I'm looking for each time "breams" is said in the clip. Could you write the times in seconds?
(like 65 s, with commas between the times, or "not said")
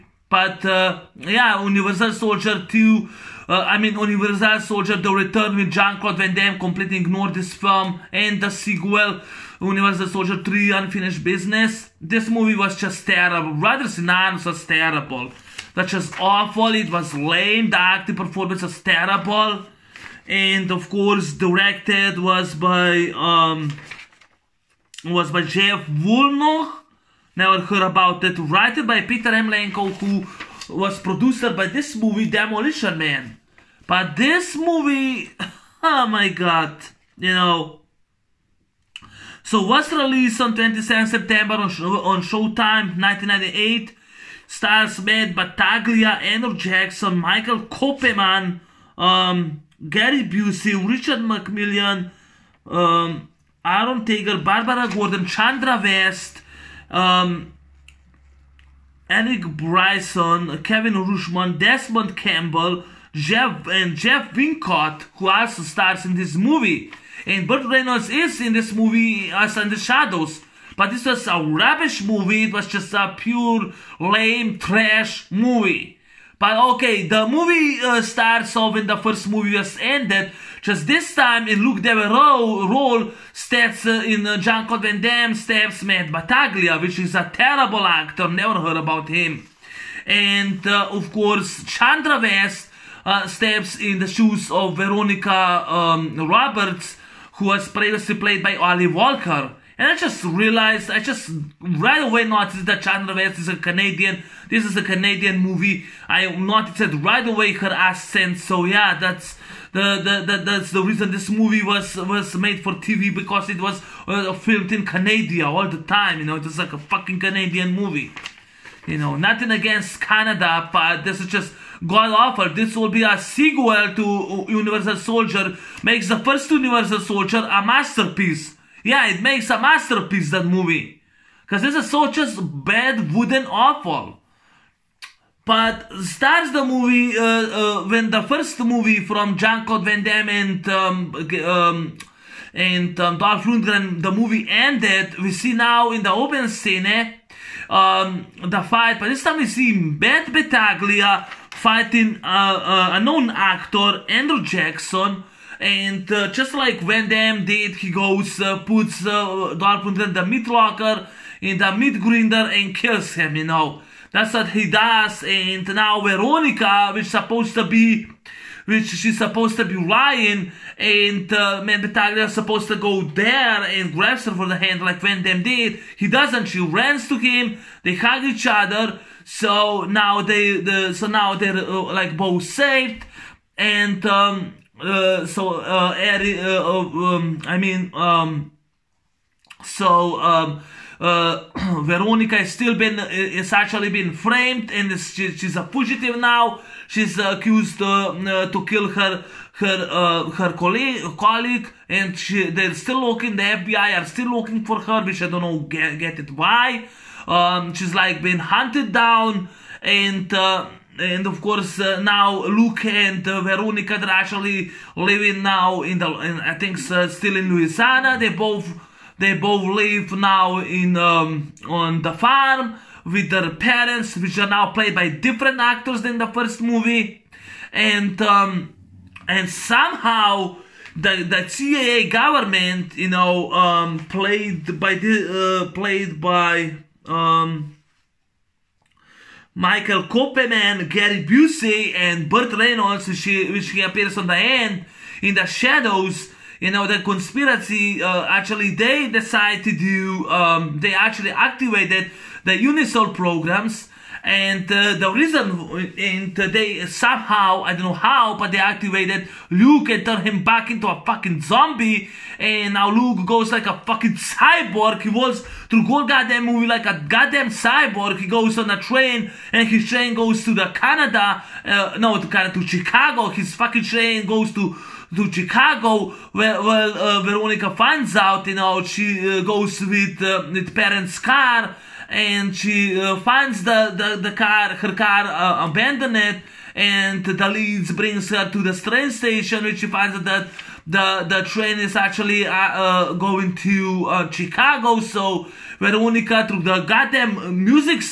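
not said.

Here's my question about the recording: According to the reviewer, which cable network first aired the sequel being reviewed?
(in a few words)
Showtime.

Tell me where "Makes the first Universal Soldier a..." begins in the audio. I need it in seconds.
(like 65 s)
125 s.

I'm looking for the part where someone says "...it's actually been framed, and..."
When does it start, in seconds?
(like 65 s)
193 s.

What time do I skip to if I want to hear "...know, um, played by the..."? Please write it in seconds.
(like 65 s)
233 s.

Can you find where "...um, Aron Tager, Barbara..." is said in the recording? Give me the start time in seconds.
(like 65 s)
52 s.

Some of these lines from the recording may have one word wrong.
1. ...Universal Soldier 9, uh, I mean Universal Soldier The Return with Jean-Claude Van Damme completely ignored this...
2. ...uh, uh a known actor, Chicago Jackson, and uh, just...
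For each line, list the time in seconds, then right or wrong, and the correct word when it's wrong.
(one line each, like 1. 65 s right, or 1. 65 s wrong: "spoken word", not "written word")
1. 1 s wrong: "2", not "9"
2. 152 s wrong: "Andrew", not "Chicago".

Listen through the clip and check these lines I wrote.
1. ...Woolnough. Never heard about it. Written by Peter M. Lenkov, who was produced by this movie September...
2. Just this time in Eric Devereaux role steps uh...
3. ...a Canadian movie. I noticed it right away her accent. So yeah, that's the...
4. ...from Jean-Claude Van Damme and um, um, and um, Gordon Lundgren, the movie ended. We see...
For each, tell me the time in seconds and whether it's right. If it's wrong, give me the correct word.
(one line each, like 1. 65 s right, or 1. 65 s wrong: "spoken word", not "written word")
1. 25 s wrong: "Demolition", not "September"
2. 80 s wrong: "Luke", not "Eric"
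3. 104 s right
4. 138 s wrong: "Dolph", not "Gordon".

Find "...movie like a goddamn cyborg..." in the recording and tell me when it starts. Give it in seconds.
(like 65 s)
266 s.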